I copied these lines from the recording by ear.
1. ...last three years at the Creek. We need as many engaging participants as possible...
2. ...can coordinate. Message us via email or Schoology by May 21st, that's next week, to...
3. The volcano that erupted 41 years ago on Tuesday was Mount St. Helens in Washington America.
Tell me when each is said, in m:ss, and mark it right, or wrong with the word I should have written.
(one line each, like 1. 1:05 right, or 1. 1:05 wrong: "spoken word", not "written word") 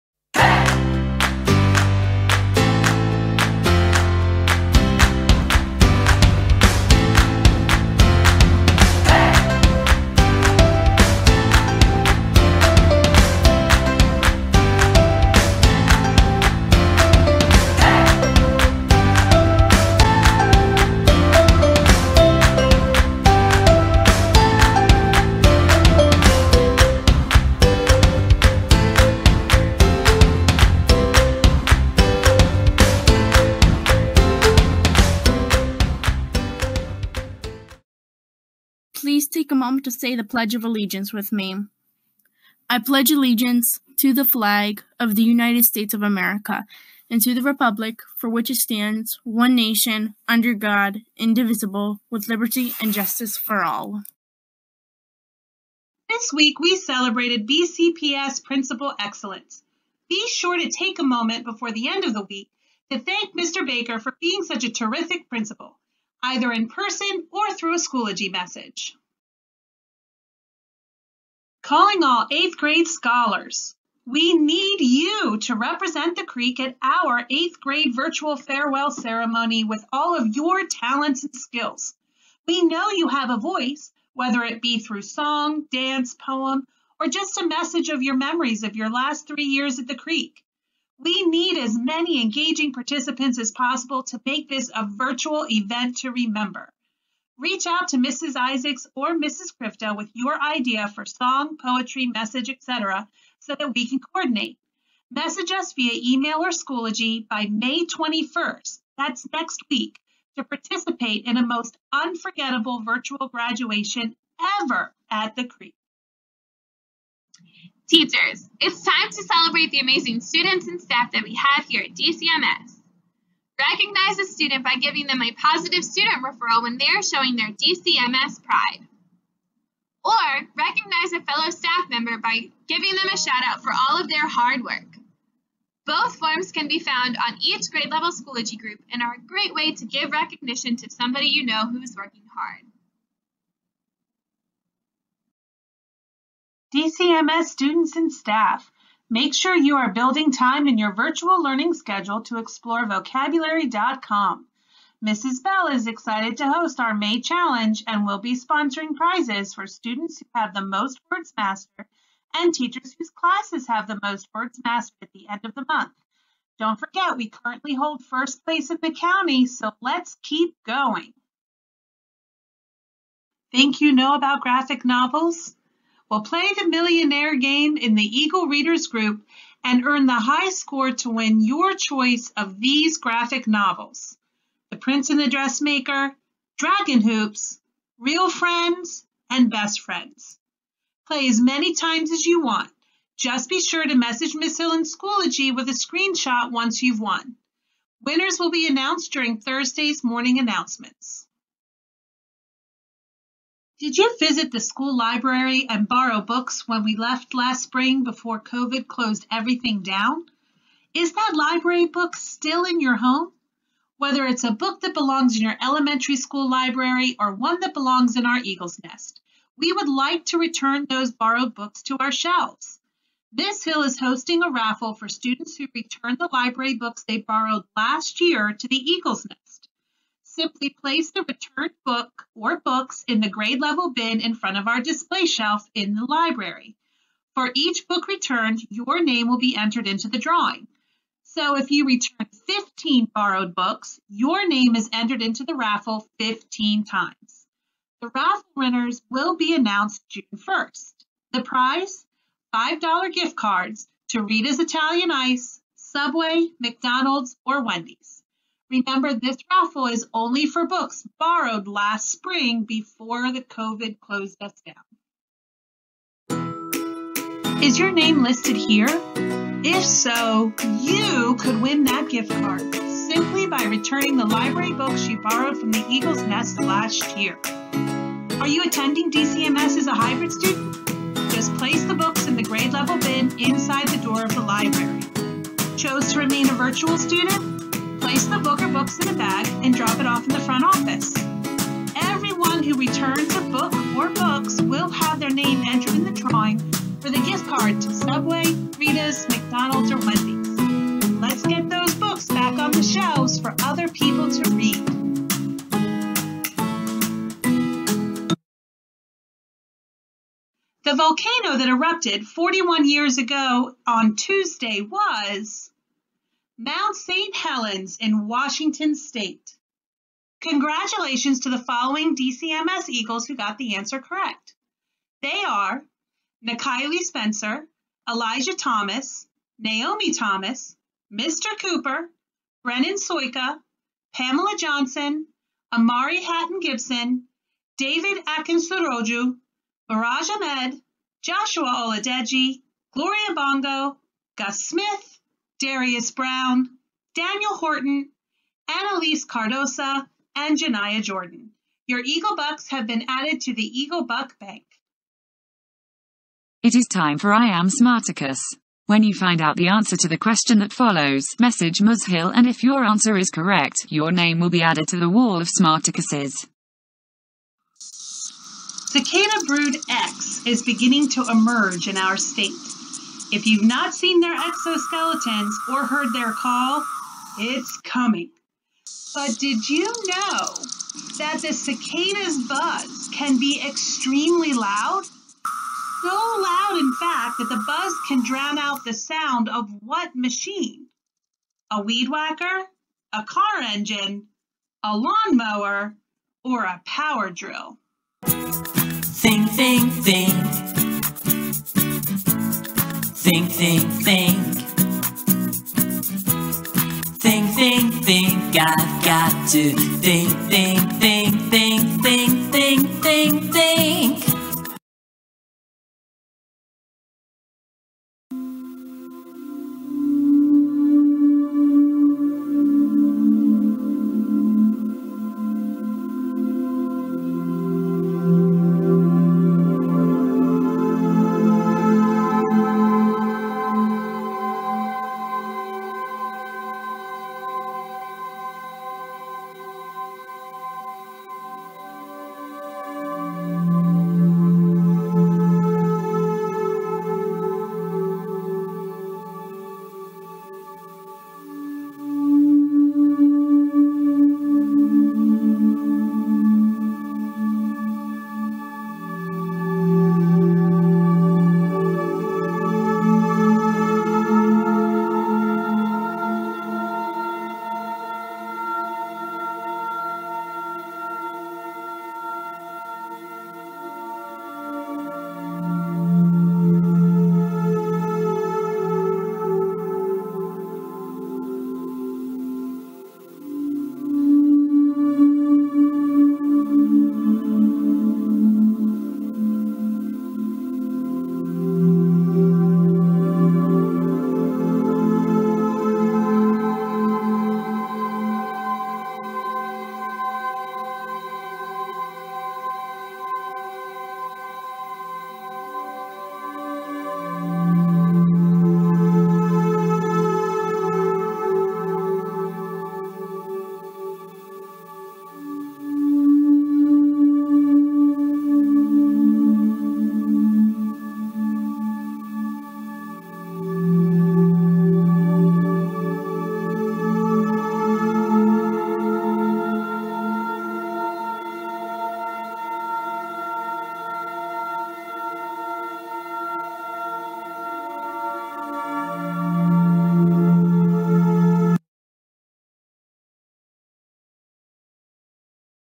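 1. 1:28 right
2. 1:43 right
3. 5:10 wrong: "State", not "America".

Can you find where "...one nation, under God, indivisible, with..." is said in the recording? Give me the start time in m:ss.
0:49.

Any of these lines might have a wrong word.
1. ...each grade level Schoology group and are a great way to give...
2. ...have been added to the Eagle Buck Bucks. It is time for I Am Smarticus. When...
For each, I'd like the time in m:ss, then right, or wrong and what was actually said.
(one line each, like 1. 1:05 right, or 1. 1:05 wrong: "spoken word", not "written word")
1. 2:17 right
2. 5:52 wrong: "Bank", not "Bucks".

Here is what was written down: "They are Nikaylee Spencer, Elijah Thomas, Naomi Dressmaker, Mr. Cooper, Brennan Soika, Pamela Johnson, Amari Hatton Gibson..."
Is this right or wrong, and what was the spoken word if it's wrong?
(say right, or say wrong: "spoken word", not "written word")
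wrong: "Thomas", not "Dressmaker".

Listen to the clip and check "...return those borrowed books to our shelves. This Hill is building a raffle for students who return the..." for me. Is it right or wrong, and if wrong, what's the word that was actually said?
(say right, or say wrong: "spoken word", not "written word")
wrong: "hosting", not "building".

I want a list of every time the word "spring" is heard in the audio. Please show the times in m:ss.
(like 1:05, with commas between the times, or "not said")
3:27, 4:22.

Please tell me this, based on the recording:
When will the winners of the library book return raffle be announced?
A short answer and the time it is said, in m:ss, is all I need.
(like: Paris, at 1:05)
June 1st, at 4:10.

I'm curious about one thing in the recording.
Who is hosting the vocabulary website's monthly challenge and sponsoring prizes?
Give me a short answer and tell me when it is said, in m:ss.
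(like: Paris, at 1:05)
Mrs. Bell, at 2:35.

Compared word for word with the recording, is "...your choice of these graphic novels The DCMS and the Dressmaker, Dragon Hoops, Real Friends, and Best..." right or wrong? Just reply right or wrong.
wrong.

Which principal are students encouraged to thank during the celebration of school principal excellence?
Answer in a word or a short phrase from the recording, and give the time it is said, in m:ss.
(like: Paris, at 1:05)
Mr. Baker, at 1:03.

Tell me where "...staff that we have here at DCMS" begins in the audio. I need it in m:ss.
2:00.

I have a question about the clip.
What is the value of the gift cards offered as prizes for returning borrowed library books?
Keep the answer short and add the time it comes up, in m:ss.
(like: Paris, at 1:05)
$5, at 4:12.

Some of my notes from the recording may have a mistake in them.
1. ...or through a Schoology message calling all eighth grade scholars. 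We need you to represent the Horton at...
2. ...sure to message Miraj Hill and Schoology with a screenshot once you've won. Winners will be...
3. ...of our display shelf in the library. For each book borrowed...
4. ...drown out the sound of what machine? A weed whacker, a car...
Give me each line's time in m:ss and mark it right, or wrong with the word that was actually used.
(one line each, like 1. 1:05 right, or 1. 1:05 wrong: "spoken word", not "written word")
1. 1:07 wrong: "Creek", not "Horton"
2. 3:13 wrong: "Miss", not "Miraj"
3. 3:54 wrong: "returned", not "borrowed"
4. 6:28 right.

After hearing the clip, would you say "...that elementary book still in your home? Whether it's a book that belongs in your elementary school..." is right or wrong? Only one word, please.
wrong.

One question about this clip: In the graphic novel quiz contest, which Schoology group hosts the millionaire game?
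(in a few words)
Eagle Readers.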